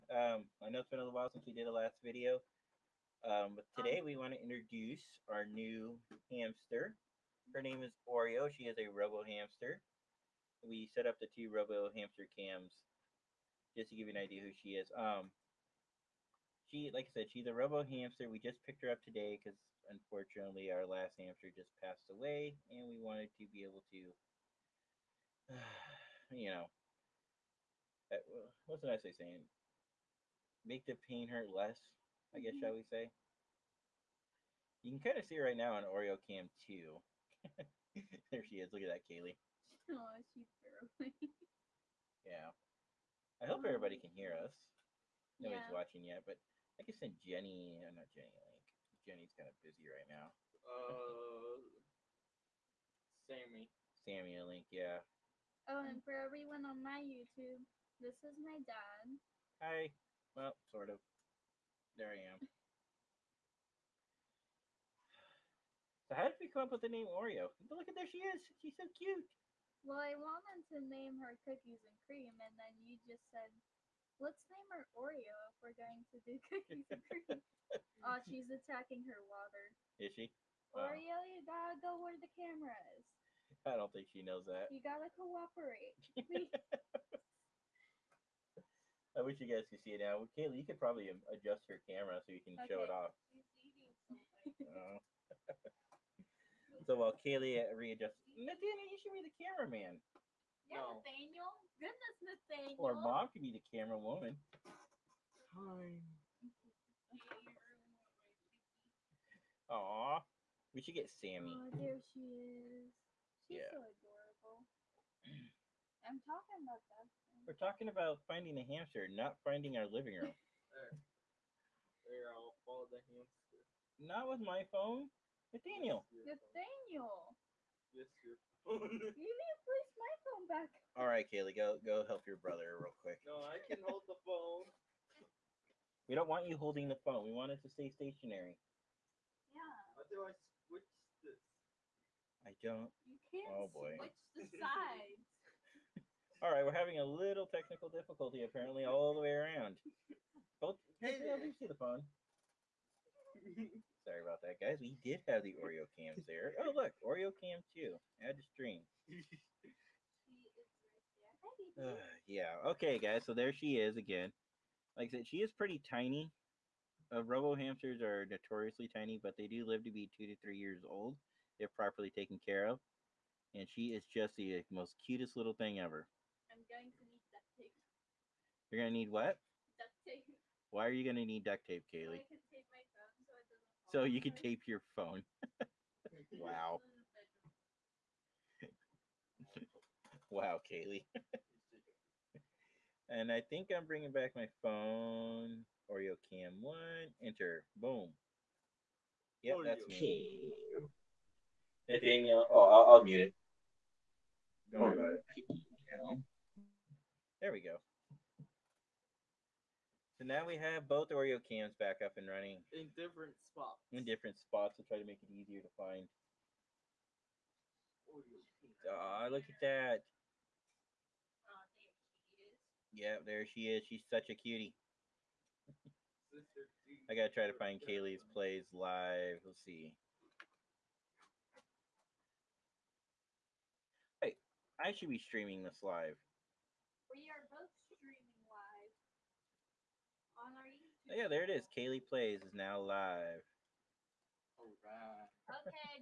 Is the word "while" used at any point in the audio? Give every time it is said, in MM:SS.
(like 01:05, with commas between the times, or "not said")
00:01, 01:36.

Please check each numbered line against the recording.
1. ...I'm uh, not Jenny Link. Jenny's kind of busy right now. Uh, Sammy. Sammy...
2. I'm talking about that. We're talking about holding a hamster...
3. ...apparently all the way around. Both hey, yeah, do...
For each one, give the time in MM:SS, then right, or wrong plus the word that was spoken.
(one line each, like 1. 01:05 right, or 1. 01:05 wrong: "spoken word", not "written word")
1. 00:47 right
2. 01:56 wrong: "finding", not "holding"
3. 02:28 right.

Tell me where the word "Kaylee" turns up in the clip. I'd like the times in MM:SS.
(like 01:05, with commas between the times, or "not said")
00:39, 01:30, 01:37, 02:11, 03:01, 03:10, 03:47, 04:01.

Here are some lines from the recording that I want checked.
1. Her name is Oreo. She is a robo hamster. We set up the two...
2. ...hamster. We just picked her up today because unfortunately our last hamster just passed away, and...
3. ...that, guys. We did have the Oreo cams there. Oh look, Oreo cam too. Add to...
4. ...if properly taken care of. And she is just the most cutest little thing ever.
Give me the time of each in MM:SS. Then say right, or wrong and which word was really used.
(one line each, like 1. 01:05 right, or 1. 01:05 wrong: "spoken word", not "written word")
1. 00:07 right
2. 00:17 right
3. 02:34 right
4. 02:51 right.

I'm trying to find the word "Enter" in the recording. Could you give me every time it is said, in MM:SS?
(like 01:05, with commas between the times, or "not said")
03:17.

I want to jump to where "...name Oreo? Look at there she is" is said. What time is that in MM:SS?
01:06.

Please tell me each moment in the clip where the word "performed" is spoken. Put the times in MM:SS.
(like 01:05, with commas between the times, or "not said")
not said.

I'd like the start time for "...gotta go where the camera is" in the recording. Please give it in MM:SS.
01:21.